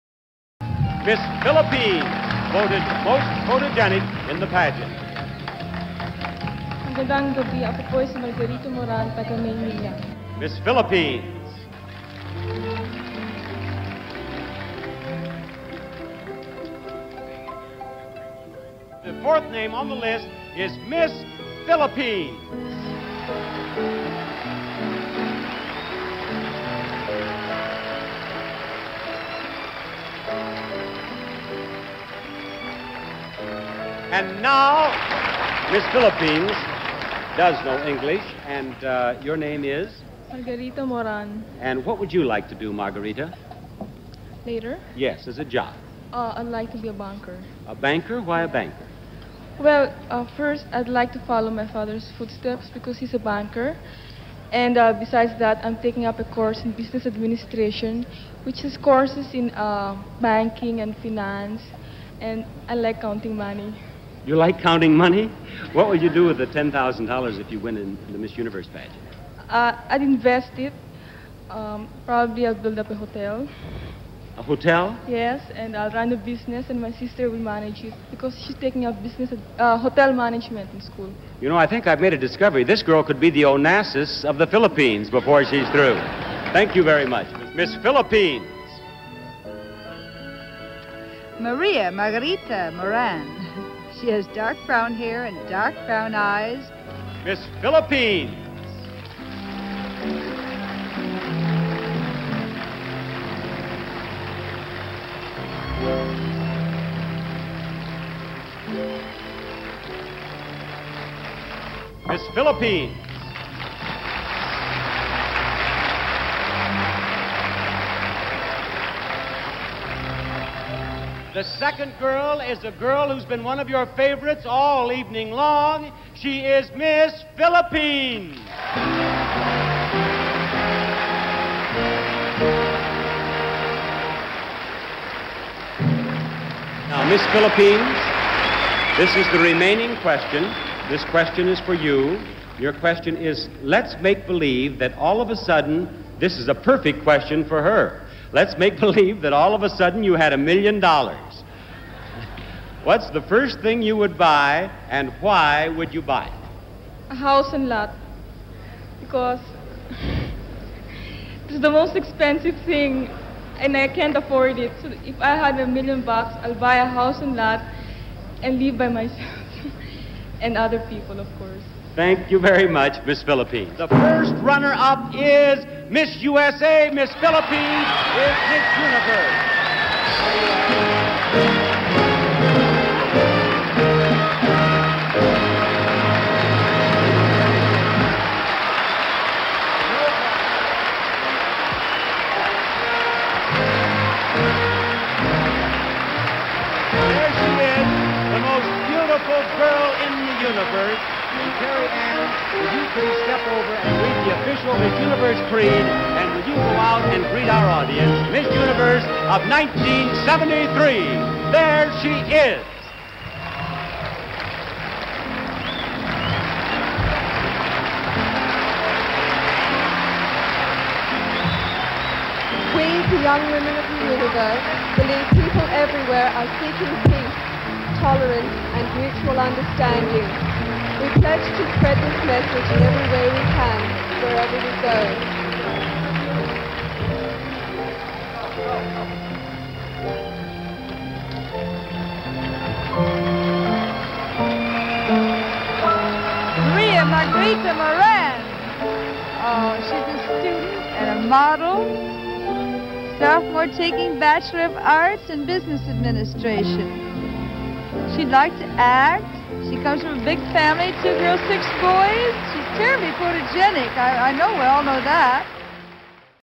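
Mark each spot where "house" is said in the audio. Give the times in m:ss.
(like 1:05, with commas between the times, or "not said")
2:37, 2:46.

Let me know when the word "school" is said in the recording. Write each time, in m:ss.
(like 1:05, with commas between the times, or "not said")
1:20.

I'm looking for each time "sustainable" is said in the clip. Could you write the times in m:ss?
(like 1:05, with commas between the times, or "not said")
not said.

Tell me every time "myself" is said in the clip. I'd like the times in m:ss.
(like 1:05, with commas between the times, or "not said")
2:48.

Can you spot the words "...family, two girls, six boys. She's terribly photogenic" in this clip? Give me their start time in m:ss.
4:20.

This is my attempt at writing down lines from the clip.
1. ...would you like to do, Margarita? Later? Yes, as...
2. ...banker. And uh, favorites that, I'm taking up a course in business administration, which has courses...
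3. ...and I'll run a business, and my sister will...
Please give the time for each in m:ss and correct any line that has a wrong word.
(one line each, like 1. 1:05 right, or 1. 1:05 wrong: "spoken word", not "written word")
1. 0:41 right
2. 0:53 wrong: "besides", not "favorites"
3. 1:15 right.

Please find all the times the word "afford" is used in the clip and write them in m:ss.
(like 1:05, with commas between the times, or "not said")
2:44.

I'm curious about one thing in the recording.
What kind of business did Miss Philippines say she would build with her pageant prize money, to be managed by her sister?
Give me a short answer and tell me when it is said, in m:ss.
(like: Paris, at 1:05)
A hotel, at 1:12.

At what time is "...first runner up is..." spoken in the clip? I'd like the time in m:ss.
2:53.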